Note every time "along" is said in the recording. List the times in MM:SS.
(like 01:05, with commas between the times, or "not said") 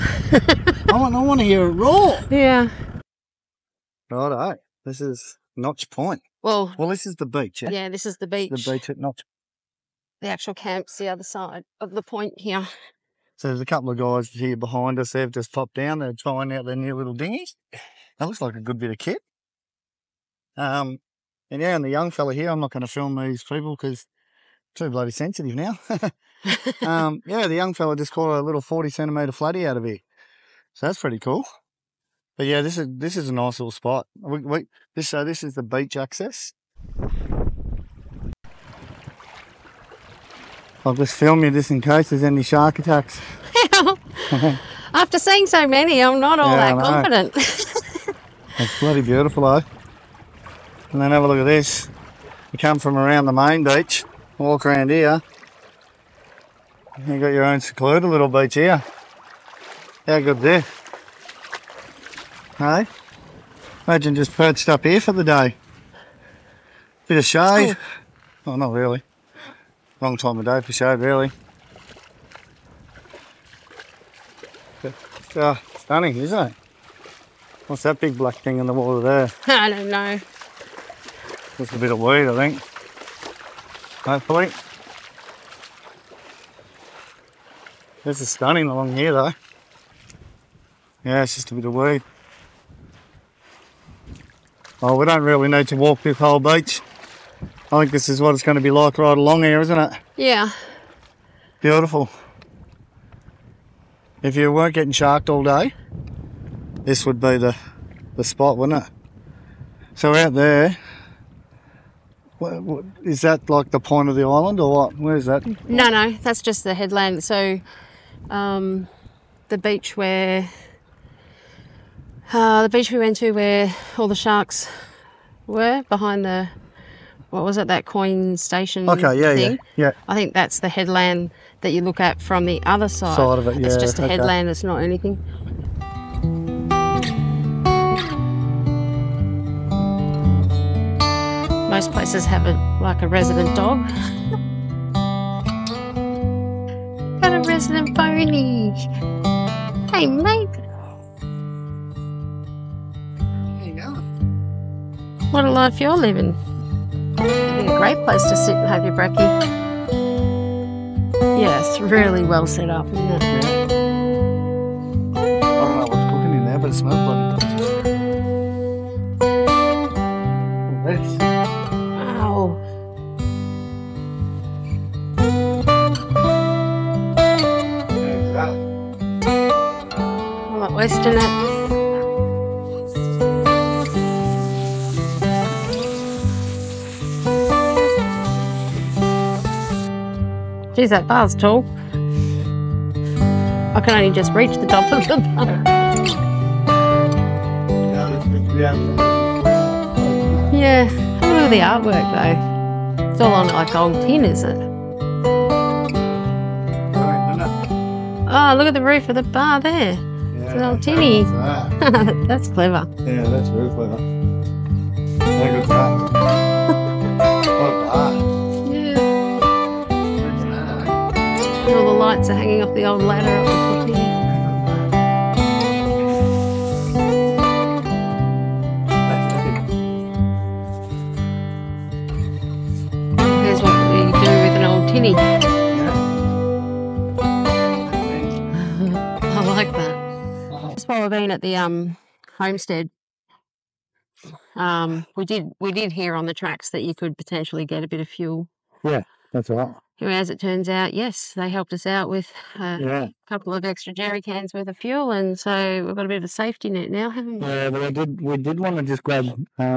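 01:28, 01:39.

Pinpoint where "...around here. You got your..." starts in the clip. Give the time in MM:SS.
00:54.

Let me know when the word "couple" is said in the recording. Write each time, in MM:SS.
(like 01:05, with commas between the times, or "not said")
00:13, 04:13.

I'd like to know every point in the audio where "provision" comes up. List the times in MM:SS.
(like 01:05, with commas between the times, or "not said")
not said.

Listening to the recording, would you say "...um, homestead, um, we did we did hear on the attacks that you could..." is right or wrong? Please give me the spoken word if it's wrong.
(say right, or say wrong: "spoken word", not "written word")
wrong: "tracks", not "attacks".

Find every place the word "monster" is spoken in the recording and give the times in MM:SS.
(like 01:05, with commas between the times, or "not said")
not said.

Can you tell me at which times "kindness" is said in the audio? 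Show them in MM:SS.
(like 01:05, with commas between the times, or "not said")
not said.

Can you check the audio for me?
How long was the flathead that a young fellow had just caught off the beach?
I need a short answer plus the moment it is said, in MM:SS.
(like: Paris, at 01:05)
40 centimeters, at 00:28.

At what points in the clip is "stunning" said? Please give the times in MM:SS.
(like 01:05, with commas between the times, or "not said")
01:15, 01:28.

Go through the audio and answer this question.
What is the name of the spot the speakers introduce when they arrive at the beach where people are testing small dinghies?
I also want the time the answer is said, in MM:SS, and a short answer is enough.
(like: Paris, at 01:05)
Notch Point, at 00:05.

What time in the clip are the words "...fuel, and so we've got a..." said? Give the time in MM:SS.
04:14.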